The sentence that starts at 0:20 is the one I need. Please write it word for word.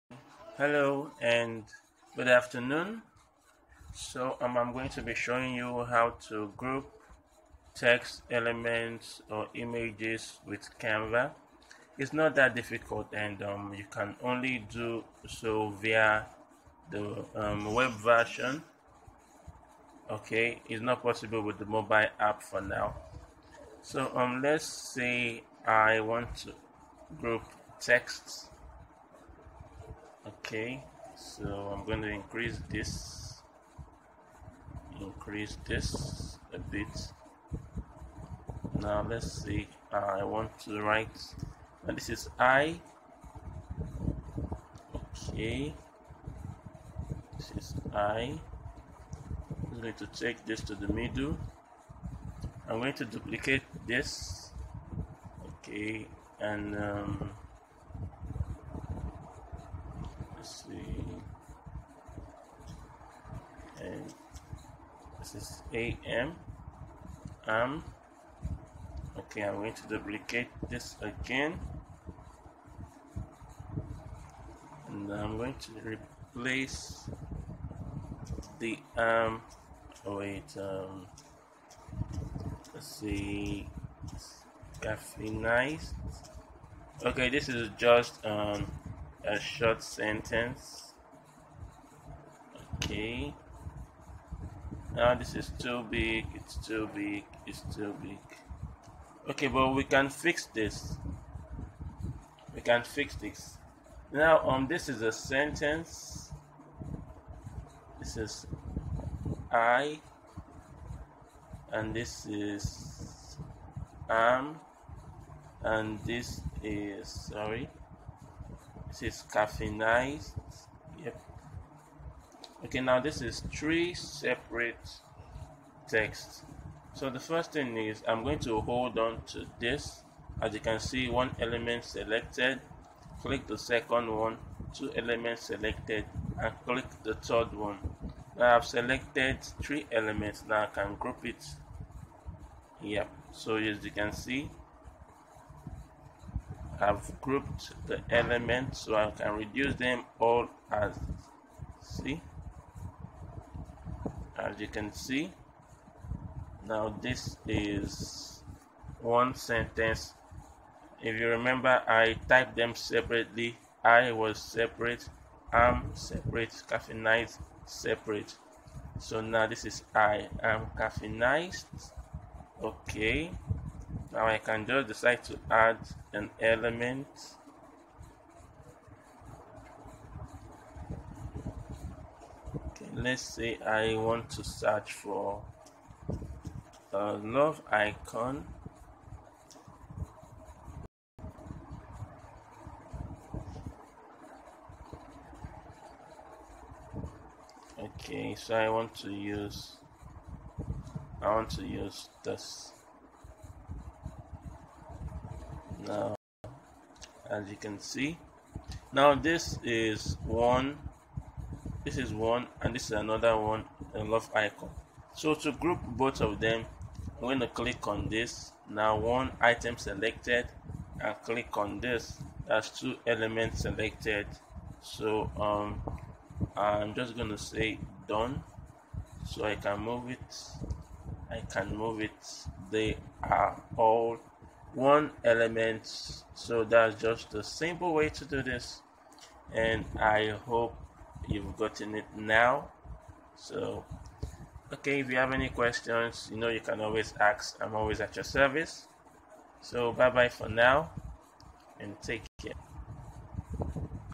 Okay, it's not possible with the mobile app for now.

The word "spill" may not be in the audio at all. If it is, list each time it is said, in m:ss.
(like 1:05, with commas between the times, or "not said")
not said.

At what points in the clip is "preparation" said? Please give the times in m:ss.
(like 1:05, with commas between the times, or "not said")
not said.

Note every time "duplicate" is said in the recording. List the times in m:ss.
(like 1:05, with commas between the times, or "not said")
0:53, 1:09.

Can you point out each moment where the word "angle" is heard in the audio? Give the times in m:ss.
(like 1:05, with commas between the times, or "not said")
not said.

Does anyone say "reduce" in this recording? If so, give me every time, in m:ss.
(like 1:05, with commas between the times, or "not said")
2:29.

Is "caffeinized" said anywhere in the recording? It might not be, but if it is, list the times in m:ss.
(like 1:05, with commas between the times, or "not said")
1:24, 1:59, 2:46, 2:50.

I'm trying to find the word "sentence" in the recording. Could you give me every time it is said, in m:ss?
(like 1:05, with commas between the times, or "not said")
1:29, 1:45, 2:39.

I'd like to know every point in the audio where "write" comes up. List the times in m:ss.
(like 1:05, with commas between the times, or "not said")
0:40.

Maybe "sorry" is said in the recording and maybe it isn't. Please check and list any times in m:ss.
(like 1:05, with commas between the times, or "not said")
1:57.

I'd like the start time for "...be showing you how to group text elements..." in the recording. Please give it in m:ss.
0:05.